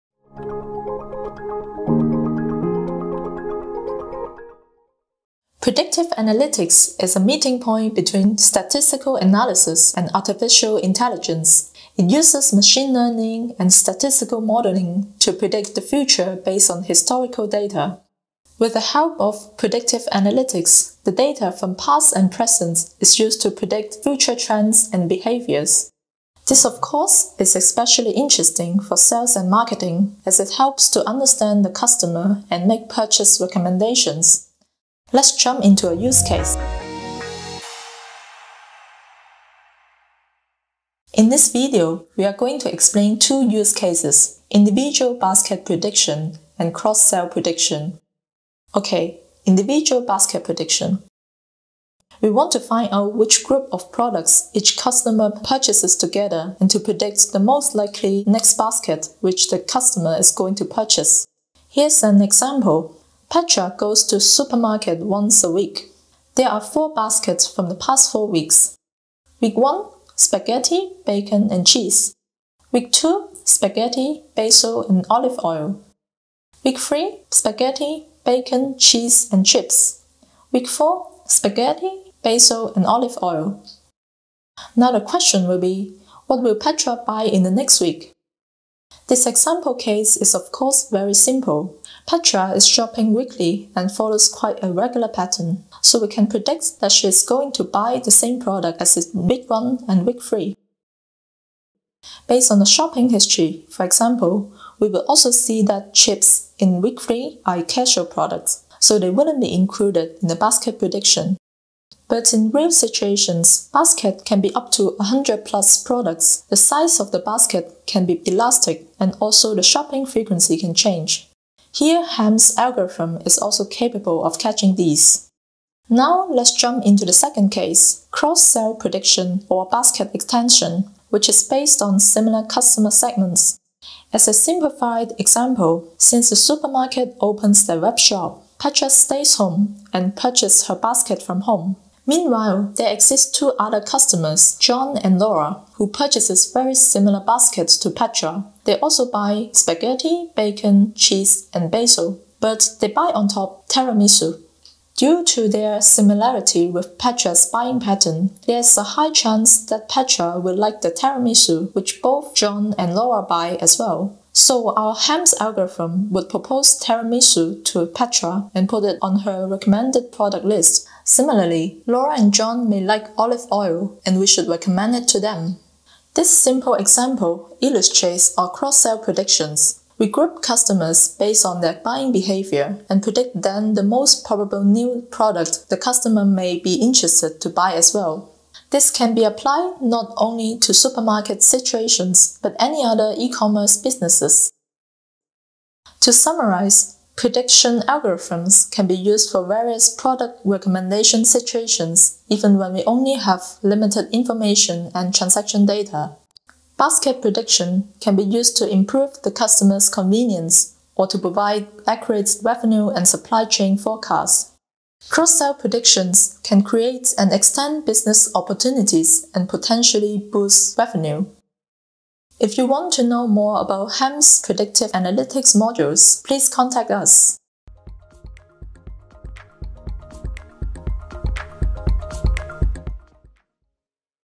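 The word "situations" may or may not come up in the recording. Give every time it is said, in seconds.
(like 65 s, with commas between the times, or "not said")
112 s, 191 s, 201 s.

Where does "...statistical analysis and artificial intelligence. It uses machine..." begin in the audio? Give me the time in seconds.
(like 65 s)
8 s.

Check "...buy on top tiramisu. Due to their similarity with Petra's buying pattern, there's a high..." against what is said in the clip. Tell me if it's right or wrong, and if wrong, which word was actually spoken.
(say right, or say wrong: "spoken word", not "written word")
right.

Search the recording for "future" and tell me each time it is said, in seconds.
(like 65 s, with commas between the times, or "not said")
15 s, 24 s.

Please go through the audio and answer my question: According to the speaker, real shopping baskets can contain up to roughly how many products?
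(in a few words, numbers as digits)
100 plus.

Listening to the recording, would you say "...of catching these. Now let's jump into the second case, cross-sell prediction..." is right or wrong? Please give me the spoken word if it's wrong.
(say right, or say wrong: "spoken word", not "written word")
right.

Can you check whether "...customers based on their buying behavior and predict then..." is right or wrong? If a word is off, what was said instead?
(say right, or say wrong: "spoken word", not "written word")
right.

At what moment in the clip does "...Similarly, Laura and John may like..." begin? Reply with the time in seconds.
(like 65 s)
171 s.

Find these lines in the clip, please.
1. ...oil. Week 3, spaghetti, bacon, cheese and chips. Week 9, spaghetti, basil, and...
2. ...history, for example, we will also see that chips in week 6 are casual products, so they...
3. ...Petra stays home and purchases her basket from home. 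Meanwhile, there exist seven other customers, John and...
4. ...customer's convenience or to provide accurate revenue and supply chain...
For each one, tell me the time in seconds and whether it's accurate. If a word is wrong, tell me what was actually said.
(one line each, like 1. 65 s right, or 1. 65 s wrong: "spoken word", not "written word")
1. 75 s wrong: "4", not "9"
2. 103 s wrong: "3", not "6"
3. 138 s wrong: "two", not "seven"
4. 209 s right.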